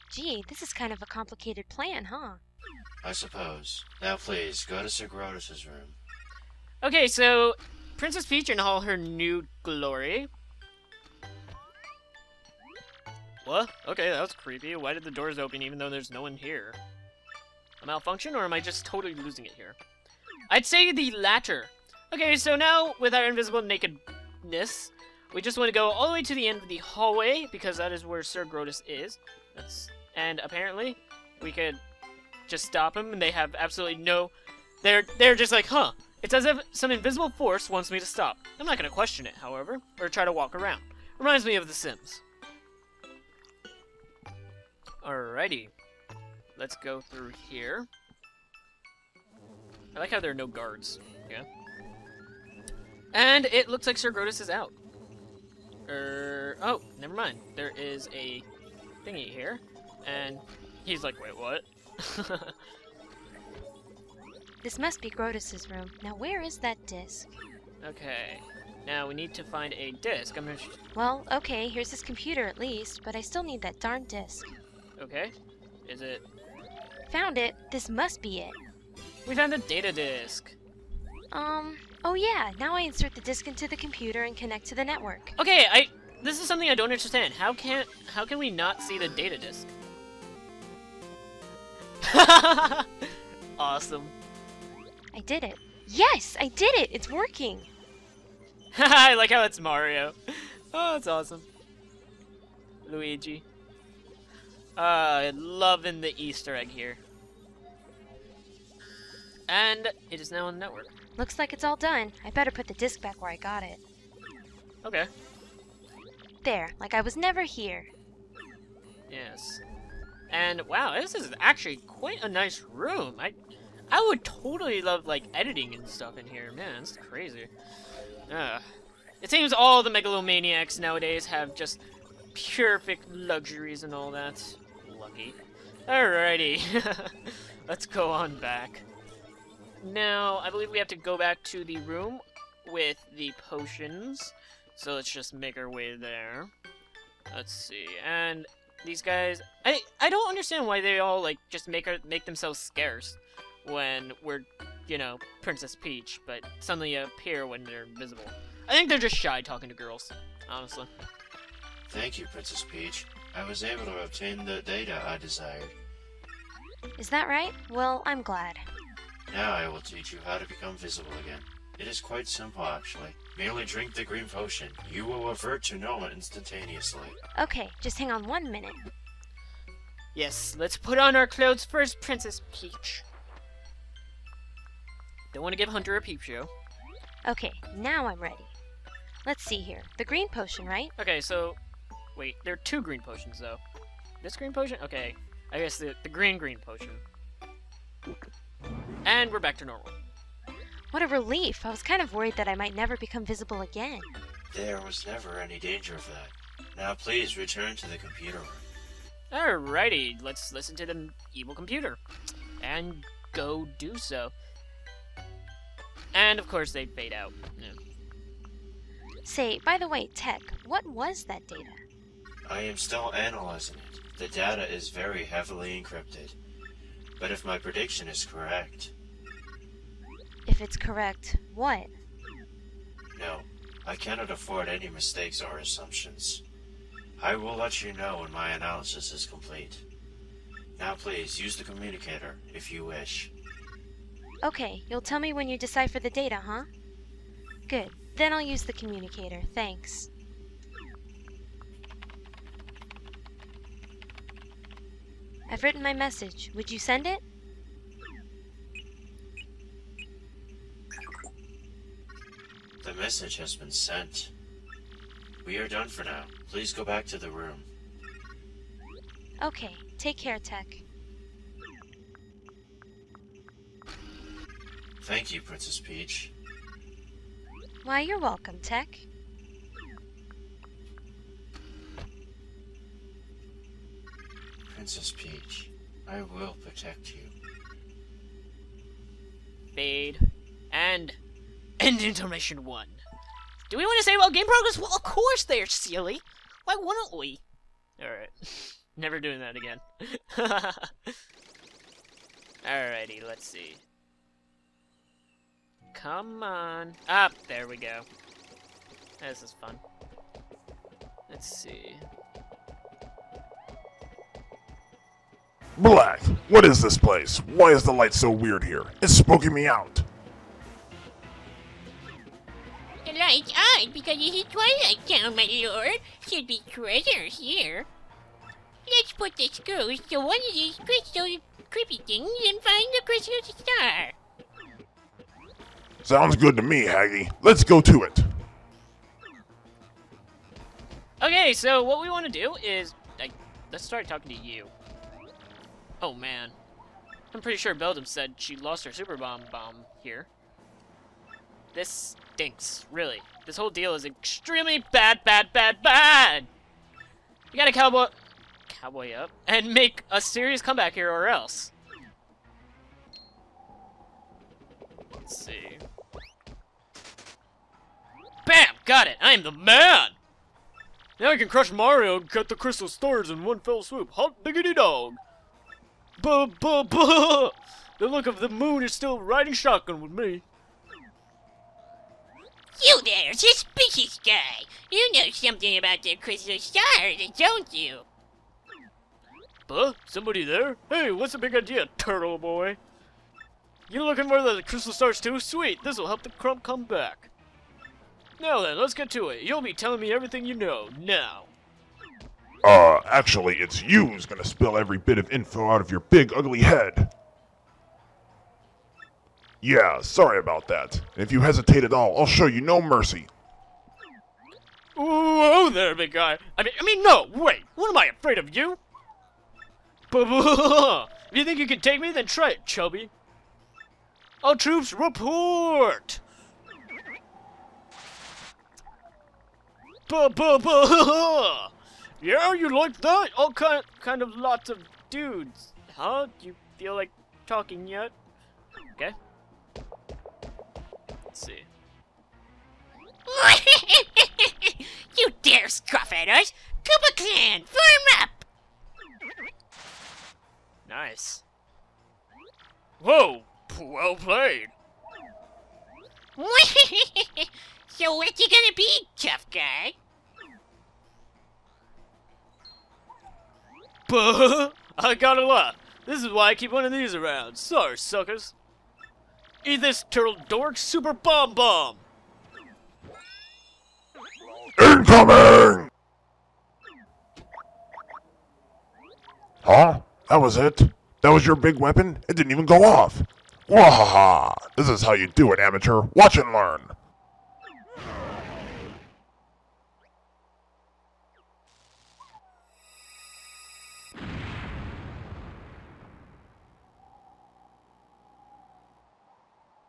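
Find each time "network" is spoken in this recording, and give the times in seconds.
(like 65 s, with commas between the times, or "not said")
84 s, 110 s.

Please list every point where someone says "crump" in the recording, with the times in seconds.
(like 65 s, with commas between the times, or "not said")
396 s.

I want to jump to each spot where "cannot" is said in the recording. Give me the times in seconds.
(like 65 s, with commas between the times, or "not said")
233 s.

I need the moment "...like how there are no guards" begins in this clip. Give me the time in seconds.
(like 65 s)
49 s.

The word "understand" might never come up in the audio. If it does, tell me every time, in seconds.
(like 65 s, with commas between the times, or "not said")
86 s, 150 s.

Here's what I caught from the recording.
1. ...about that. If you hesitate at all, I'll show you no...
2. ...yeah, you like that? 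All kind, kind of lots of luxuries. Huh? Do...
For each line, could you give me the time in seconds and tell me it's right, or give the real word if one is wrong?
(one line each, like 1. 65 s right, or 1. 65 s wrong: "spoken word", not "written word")
1. 410 s right
2. 432 s wrong: "dudes", not "luxuries".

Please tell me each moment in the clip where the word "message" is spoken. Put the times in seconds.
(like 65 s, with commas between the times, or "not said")
255 s, 262 s.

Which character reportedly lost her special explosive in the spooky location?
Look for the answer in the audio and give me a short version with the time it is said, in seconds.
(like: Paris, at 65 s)
Beldam, at 347 s.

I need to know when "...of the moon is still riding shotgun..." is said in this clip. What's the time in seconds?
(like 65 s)
378 s.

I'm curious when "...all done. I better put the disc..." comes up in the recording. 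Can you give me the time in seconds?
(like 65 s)
111 s.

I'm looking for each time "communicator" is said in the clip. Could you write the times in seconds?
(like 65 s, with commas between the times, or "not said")
241 s, 248 s.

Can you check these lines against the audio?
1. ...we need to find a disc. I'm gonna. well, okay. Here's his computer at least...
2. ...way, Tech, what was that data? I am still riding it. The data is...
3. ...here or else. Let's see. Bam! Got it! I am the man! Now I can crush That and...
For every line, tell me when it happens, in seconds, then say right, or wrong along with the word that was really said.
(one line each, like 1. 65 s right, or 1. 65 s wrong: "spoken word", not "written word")
1. 69 s right
2. 219 s wrong: "analyzing", not "riding"
3. 360 s wrong: "Mario", not "That".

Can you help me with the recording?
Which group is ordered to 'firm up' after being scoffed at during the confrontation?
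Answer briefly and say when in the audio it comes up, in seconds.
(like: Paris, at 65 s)
Koopa Clan, at 446 s.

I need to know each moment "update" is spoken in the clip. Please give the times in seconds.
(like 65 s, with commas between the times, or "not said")
not said.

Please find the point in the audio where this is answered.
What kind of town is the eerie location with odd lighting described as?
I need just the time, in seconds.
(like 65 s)
324 s.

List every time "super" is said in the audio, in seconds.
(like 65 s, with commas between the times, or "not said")
348 s, 470 s.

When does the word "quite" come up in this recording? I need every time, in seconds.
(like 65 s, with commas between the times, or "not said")
121 s, 171 s.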